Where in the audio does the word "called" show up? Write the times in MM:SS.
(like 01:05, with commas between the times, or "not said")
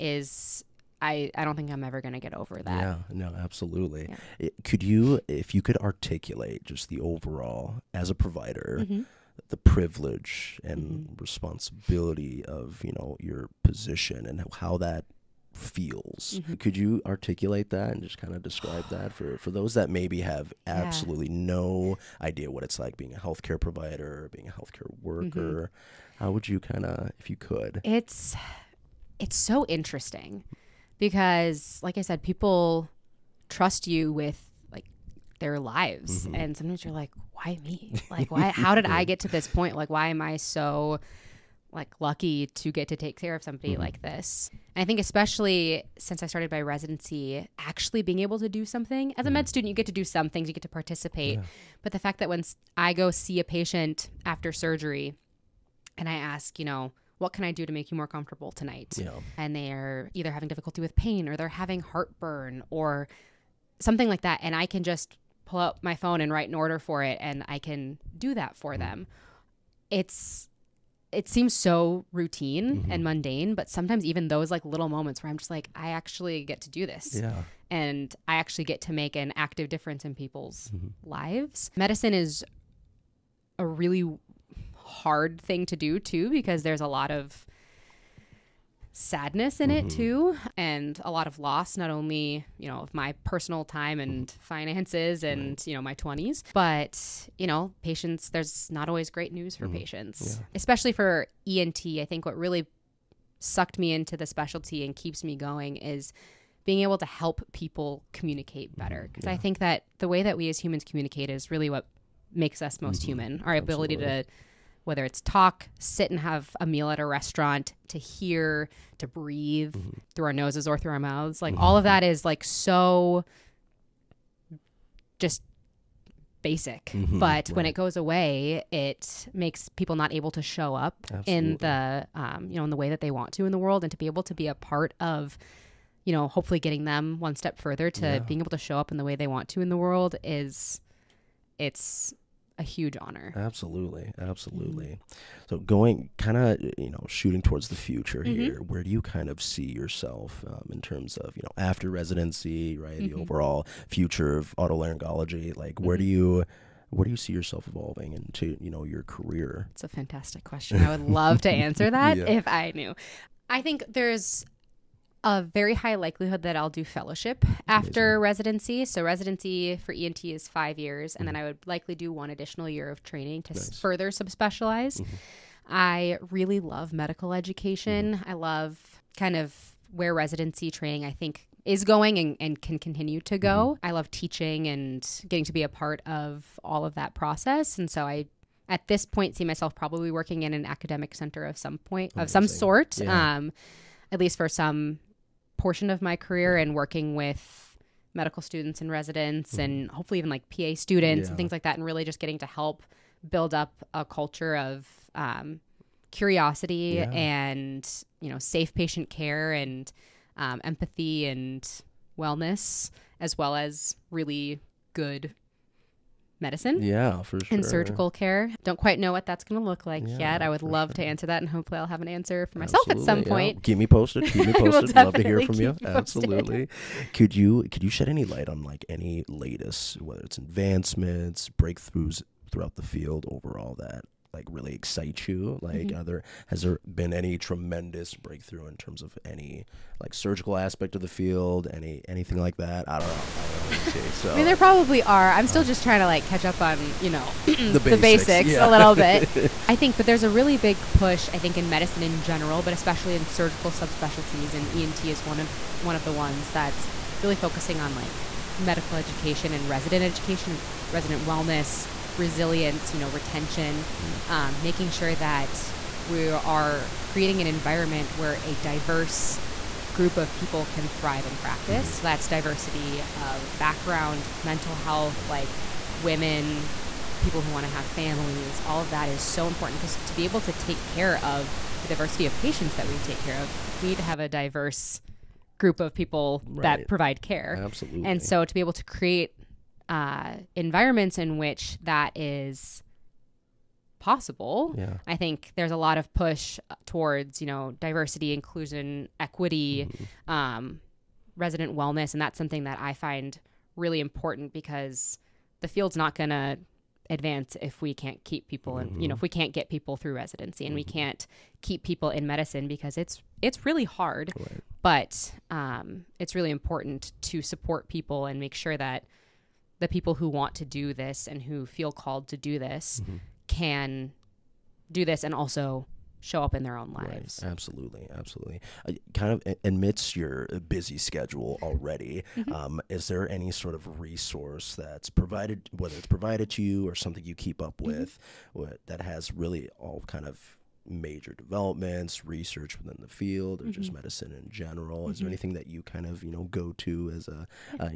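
05:21.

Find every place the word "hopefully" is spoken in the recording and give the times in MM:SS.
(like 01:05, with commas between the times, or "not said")
02:16, 03:19, 03:41.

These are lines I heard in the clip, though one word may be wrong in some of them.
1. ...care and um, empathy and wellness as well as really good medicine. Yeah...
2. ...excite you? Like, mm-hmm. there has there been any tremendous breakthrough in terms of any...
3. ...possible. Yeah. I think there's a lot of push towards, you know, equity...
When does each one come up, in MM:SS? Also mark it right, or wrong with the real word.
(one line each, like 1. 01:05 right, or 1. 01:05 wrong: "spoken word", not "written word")
1. 03:29 right
2. 03:54 right
3. 04:53 wrong: "diversity", not "equity".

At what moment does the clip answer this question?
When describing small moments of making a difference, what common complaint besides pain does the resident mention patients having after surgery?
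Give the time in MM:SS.
01:01.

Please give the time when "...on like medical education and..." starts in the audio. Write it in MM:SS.
04:17.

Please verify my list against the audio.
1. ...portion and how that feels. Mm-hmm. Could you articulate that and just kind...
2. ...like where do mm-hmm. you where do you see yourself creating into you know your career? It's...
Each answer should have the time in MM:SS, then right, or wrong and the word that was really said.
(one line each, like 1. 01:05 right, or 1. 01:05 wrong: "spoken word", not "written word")
1. 00:13 wrong: "position", not "portion"
2. 02:35 wrong: "evolving", not "creating".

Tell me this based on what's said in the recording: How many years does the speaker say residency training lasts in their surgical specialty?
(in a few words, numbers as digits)
5.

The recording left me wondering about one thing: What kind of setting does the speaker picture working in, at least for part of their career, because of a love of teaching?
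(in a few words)
Academic center.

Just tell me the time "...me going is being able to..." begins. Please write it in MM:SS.
01:45.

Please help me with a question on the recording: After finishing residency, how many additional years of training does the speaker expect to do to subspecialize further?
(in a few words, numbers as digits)
1.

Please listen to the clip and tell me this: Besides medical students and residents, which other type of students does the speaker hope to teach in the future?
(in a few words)
PA students.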